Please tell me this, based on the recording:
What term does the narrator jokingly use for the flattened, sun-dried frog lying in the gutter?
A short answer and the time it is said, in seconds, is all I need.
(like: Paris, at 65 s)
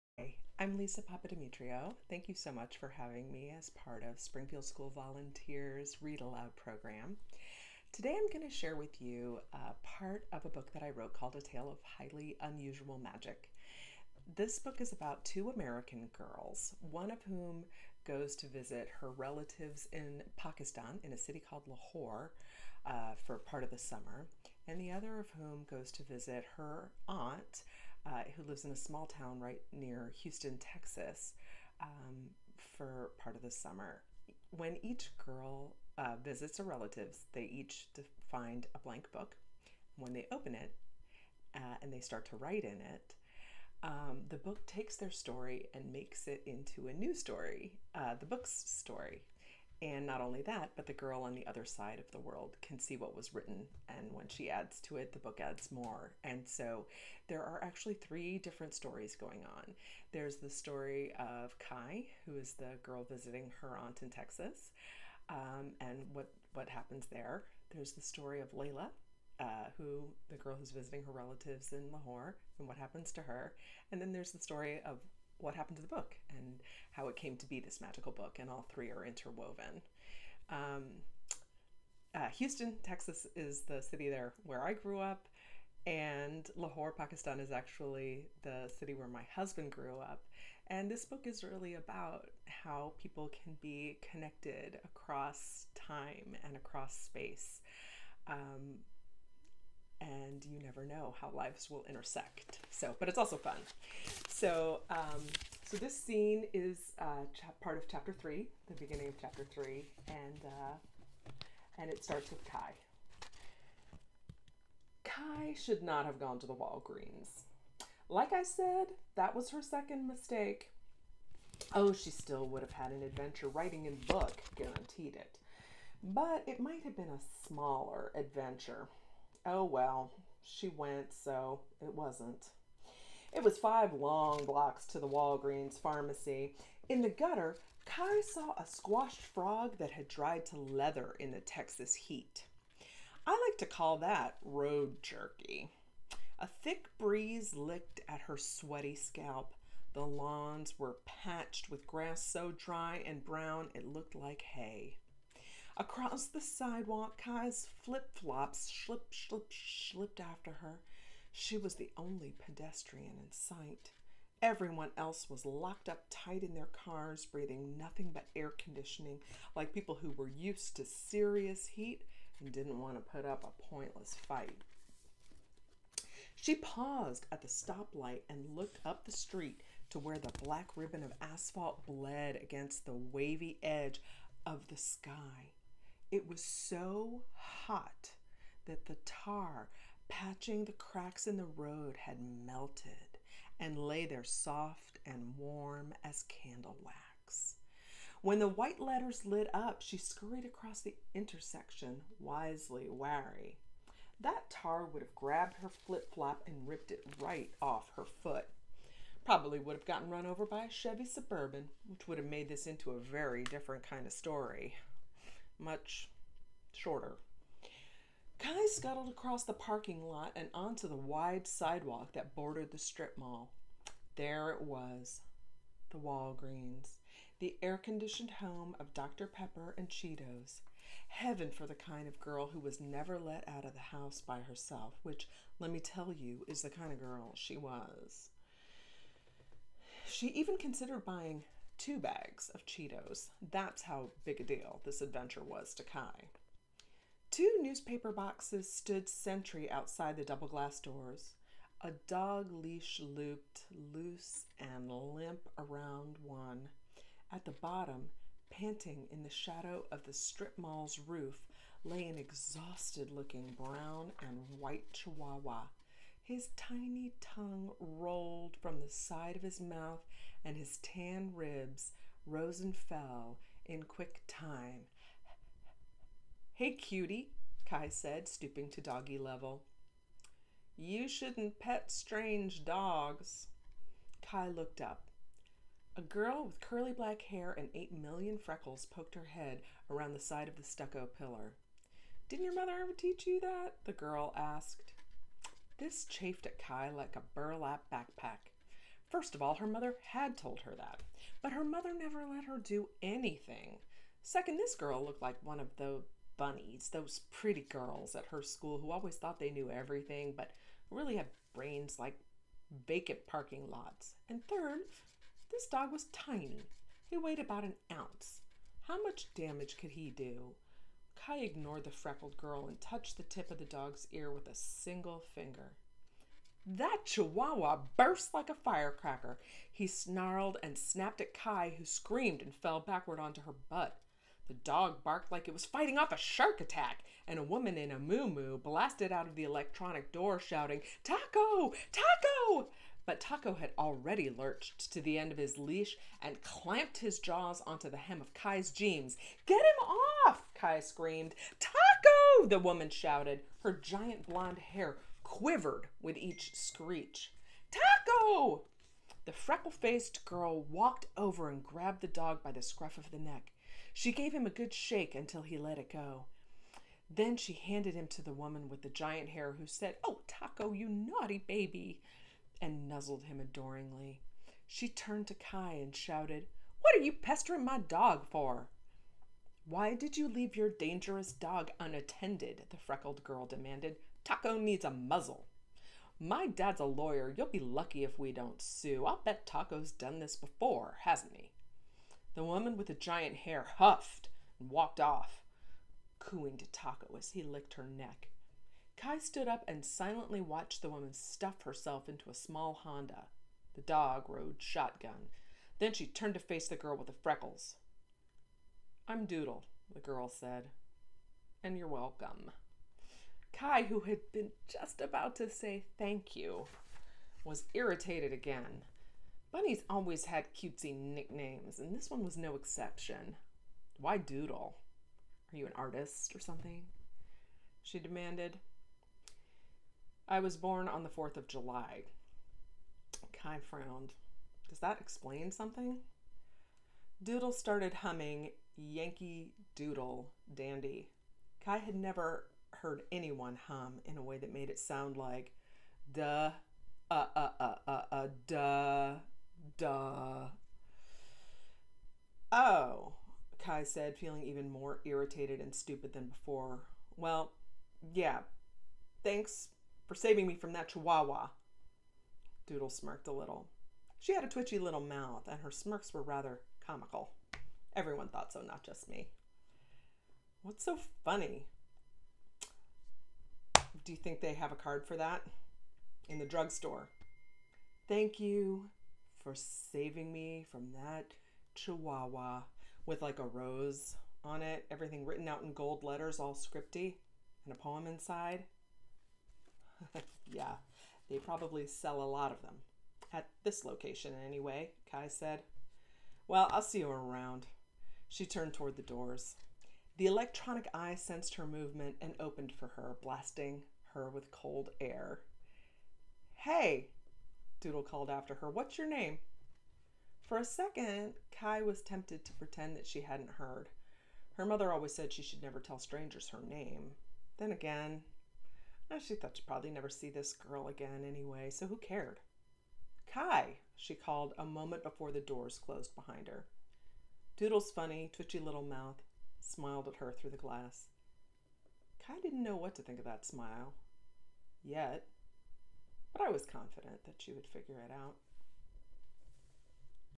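road jerky, at 144 s.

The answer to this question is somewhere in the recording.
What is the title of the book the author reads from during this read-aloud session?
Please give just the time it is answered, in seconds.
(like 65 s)
11 s.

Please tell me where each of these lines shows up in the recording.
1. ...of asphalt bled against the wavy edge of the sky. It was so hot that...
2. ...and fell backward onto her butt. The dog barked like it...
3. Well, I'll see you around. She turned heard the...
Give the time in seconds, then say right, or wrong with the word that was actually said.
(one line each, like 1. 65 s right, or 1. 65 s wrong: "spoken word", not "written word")
1. 181 s right
2. 332 s right
3. 496 s wrong: "toward", not "heard".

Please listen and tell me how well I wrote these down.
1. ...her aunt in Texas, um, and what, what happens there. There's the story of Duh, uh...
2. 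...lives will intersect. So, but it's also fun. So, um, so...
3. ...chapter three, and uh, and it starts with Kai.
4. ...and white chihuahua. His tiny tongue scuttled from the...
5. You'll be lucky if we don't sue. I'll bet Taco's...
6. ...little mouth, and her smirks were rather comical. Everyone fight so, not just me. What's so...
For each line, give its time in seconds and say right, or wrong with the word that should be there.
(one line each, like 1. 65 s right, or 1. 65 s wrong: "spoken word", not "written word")
1. 63 s wrong: "Leila", not "Duh"
2. 101 s right
3. 109 s right
4. 264 s wrong: "rolled", not "scuttled"
5. 387 s right
6. 464 s wrong: "thought", not "fight".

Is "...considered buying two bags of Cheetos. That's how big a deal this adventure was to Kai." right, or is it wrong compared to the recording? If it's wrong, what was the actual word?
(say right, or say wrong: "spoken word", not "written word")
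right.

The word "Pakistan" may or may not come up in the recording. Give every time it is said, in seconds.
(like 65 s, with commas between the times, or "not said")
20 s, 86 s.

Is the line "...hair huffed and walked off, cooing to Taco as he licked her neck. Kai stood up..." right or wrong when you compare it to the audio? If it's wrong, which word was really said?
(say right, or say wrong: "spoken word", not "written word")
right.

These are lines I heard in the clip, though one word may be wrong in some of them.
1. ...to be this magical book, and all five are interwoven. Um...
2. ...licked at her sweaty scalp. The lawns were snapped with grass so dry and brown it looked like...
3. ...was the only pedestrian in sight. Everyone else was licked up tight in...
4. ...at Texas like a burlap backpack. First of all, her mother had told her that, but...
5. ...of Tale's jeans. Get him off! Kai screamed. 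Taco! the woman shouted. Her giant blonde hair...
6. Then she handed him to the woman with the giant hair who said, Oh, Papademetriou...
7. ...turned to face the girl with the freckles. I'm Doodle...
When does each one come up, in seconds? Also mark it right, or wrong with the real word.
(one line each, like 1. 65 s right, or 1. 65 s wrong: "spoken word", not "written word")
1. 77 s wrong: "three", not "five"
2. 147 s wrong: "patched", not "snapped"
3. 161 s wrong: "locked", not "licked"
4. 296 s wrong: "Kai", not "Texas"
5. 348 s wrong: "Kai", not "Tale"
6. 367 s wrong: "Taco", not "Papademetriou"
7. 406 s right.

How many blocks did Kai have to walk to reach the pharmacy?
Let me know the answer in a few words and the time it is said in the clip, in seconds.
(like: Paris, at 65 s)
5, at 133 s.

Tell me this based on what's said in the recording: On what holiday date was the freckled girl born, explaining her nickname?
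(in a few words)
4th of July.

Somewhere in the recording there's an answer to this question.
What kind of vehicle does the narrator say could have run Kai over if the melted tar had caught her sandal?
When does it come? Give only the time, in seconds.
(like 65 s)
210 s.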